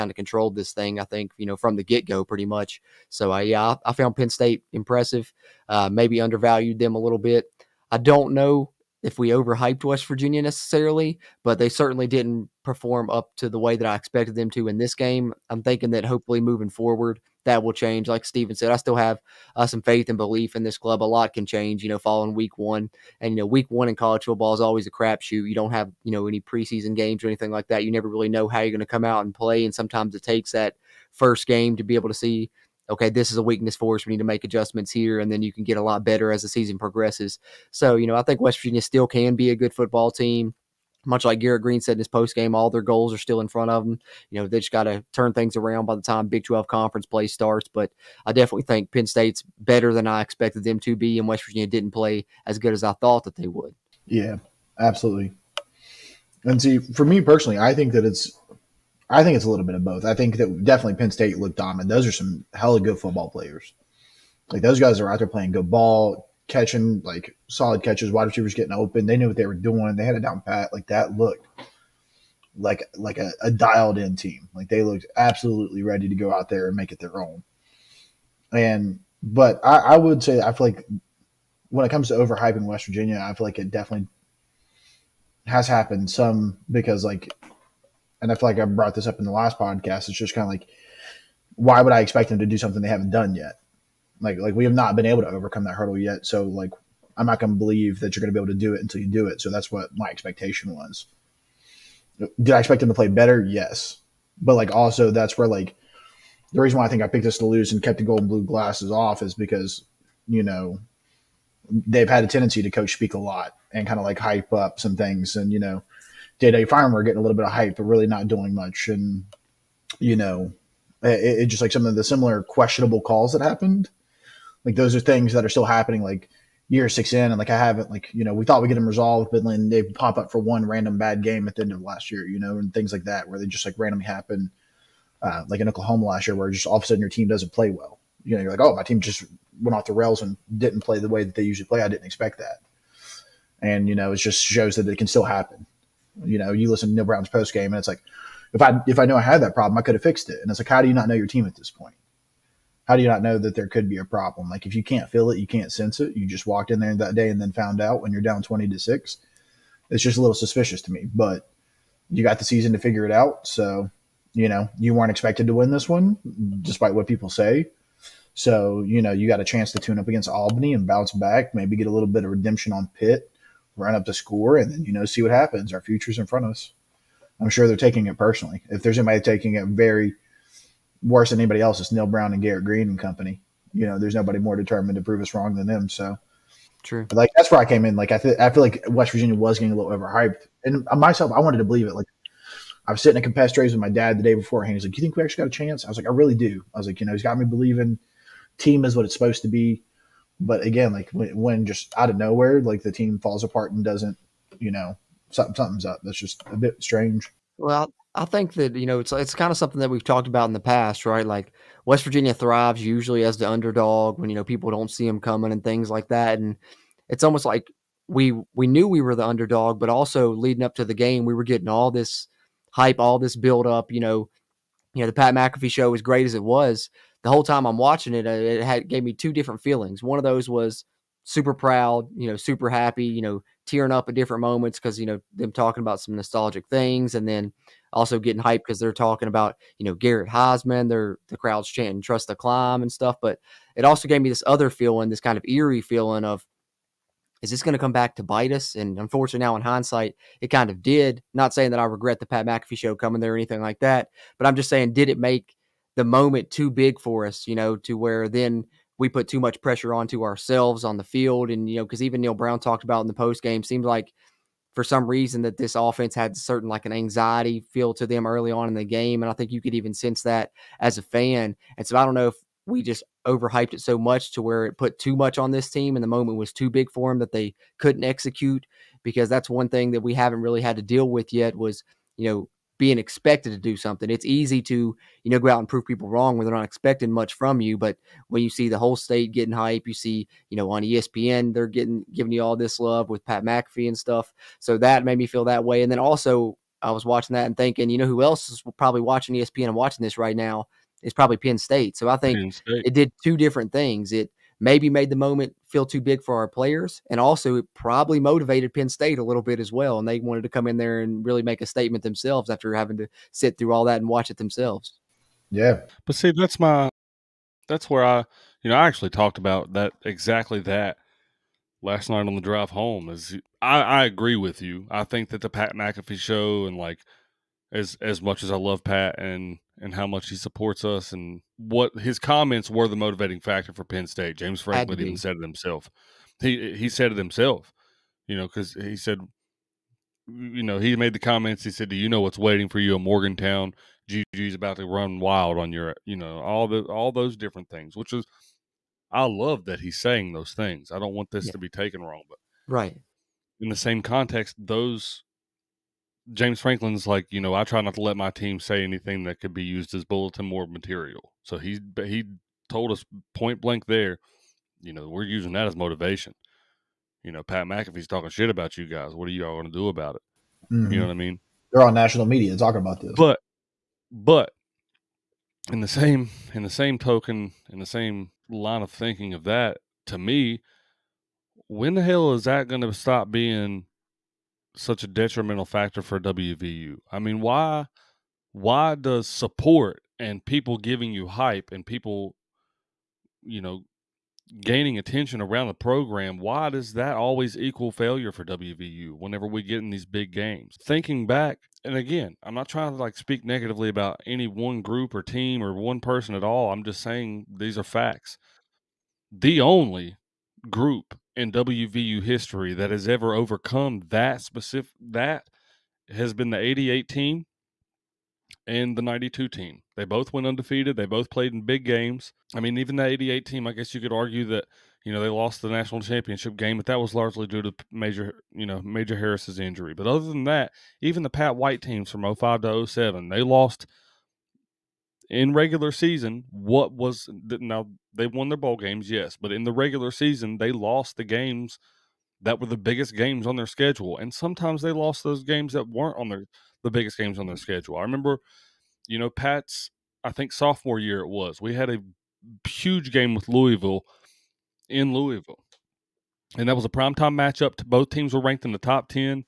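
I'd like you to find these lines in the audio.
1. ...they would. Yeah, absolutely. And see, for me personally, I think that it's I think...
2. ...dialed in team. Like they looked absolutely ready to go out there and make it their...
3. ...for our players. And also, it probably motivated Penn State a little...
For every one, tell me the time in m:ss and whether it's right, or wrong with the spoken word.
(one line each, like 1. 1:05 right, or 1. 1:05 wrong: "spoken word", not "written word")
1. 0:53 right
2. 1:13 right
3. 5:06 right.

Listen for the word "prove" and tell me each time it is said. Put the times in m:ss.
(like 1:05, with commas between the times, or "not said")
3:05, 4:45.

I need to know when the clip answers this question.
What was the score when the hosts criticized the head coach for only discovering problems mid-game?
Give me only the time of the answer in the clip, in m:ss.
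2:38.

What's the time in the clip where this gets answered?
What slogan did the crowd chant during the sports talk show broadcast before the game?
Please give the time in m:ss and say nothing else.
4:01.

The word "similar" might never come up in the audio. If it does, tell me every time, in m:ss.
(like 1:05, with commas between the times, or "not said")
2:02.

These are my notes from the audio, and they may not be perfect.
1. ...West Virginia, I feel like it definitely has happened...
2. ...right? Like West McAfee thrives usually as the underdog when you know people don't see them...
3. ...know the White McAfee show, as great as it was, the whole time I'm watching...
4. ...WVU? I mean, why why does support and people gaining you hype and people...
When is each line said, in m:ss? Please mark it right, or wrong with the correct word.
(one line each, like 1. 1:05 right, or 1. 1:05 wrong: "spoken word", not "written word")
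1. 1:22 right
2. 3:31 wrong: "Virginia", not "McAfee"
3. 3:45 wrong: "Pat", not "White"
4. 6:26 wrong: "giving", not "gaining".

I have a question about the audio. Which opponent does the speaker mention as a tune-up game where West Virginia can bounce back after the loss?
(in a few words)
Albany.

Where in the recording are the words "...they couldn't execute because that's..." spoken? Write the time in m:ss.
4:37.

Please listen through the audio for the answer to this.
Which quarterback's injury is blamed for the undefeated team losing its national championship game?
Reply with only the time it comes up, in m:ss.
7:08.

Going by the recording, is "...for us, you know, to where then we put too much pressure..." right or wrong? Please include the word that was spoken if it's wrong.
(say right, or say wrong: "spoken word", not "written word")
right.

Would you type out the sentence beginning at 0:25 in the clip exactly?
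You don't have, you know, any preseason games or anything like that.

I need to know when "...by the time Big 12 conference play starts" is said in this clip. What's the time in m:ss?
0:45.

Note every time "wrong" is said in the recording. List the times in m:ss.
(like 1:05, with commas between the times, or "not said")
3:05, 4:46, 5:52.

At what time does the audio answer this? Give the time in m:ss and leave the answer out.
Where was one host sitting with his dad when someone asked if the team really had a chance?
3:13.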